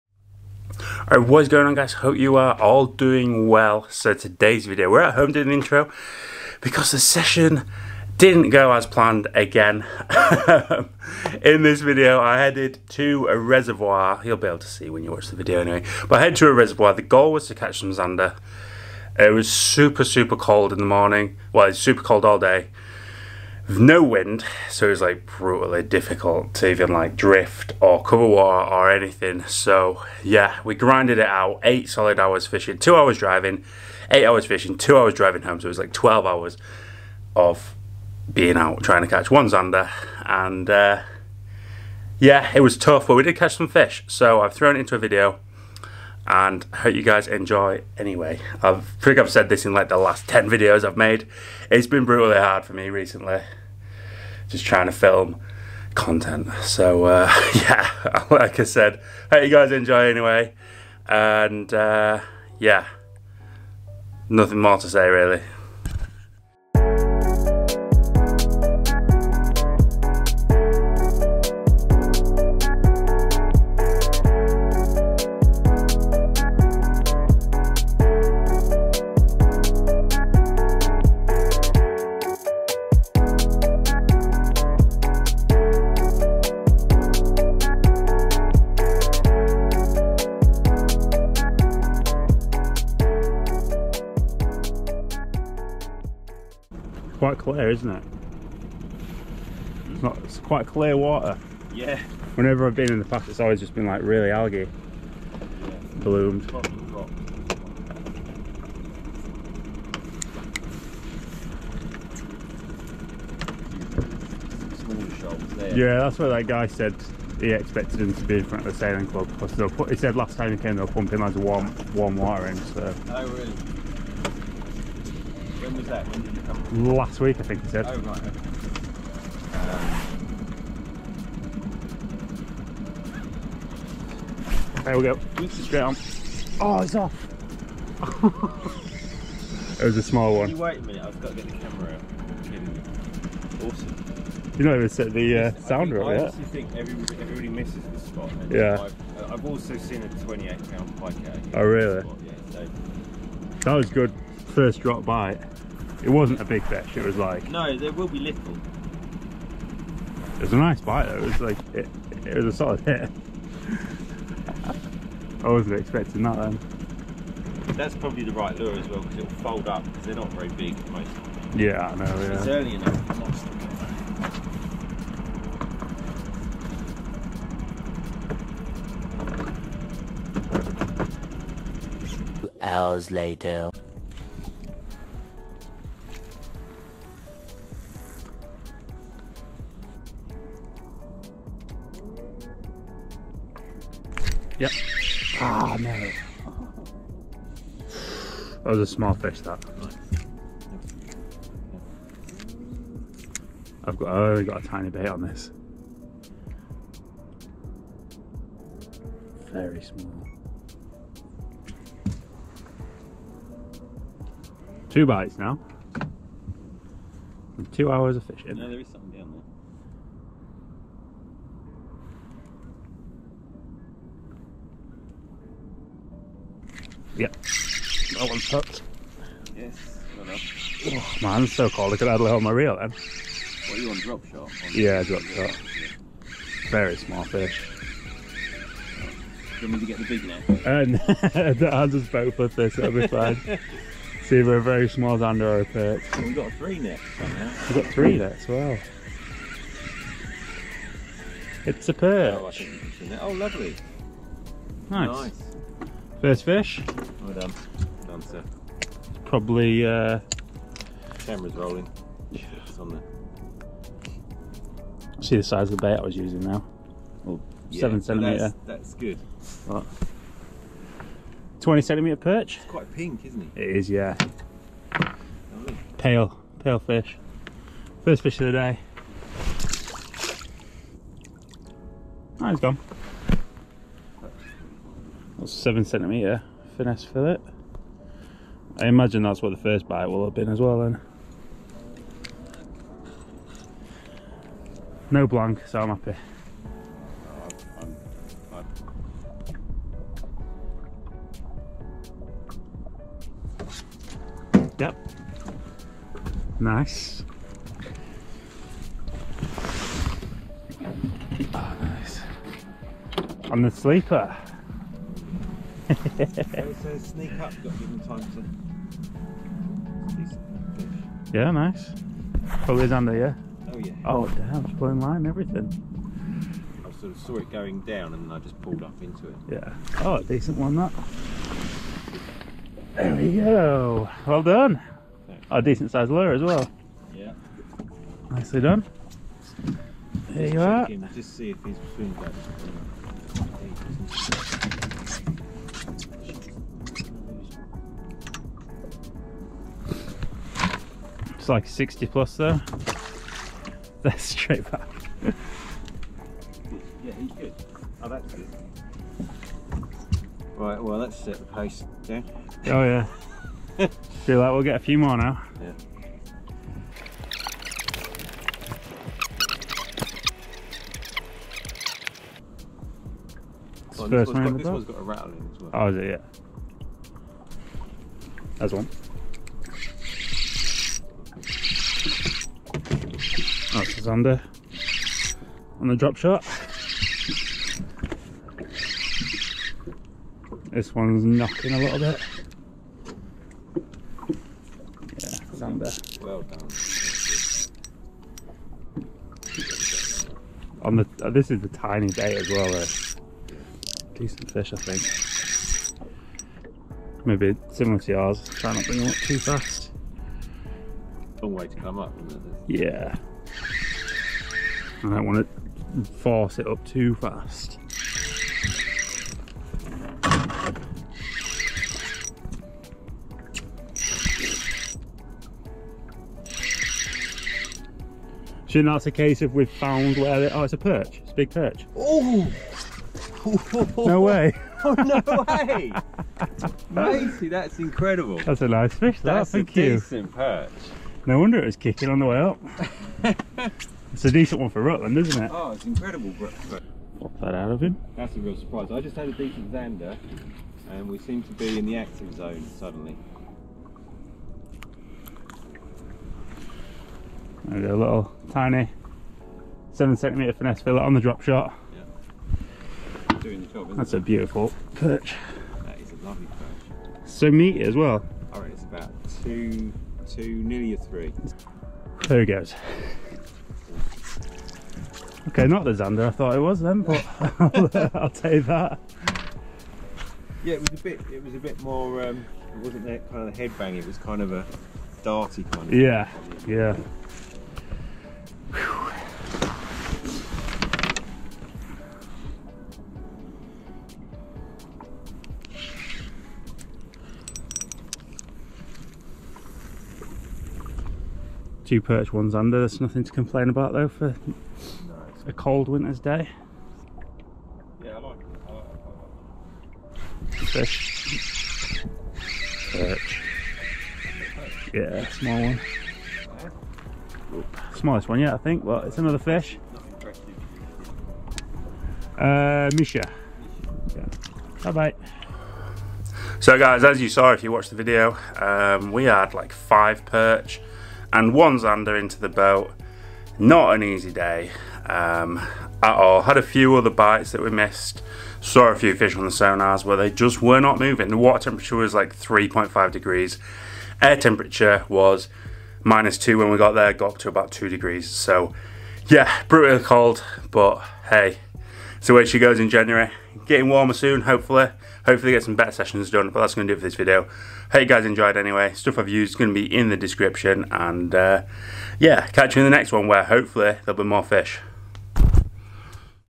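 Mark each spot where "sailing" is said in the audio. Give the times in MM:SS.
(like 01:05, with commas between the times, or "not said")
01:58.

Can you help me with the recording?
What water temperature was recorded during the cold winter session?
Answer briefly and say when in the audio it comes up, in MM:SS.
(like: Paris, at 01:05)
3.5 degrees, at 09:02.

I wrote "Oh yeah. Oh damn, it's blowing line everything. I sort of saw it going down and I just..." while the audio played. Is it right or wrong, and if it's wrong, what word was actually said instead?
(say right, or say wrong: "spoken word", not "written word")
right.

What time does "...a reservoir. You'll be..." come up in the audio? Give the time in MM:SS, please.
00:13.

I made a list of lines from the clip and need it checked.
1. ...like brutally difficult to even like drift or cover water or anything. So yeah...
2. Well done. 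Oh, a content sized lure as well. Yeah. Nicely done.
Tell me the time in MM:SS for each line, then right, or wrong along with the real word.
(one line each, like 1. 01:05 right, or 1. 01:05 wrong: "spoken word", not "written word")
1. 00:25 right
2. 05:34 wrong: "decent", not "content".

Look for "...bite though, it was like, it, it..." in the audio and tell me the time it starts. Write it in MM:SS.
02:40.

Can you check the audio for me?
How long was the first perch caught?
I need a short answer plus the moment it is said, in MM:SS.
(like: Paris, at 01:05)
20 centimeters, at 04:31.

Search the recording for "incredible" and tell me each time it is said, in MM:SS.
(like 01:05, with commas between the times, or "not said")
07:17, 07:25.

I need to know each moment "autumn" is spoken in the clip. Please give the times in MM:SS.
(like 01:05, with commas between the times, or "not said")
not said.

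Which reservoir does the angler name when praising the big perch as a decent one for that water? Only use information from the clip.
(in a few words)
Rutland.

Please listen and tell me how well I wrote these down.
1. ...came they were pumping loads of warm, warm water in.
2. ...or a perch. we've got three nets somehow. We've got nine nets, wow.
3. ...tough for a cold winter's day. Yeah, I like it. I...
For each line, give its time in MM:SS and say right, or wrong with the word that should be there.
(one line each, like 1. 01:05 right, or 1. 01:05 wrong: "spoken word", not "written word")
1. 02:00 right
2. 04:05 wrong: "three", not "nine"
3. 08:23 wrong: "though", not "tough".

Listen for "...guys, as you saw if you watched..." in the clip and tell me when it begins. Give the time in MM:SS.
08:46.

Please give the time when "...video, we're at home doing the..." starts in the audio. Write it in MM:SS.
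00:04.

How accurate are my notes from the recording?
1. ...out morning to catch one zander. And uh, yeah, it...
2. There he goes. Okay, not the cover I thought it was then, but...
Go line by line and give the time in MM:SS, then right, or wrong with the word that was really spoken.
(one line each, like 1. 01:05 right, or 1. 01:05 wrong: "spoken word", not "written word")
1. 00:38 wrong: "trying", not "morning"
2. 07:52 wrong: "zander", not "cover".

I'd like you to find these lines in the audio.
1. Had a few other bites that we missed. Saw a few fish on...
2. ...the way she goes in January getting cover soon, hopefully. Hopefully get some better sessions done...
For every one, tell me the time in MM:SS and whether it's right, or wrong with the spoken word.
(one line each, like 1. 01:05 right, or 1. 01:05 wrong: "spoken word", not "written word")
1. 08:56 right
2. 09:12 wrong: "warmer", not "cover".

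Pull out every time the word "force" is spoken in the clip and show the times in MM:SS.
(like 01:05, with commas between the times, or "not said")
06:56.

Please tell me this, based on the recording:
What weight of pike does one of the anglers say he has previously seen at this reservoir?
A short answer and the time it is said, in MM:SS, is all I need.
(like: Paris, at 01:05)
28 pounds, at 02:30.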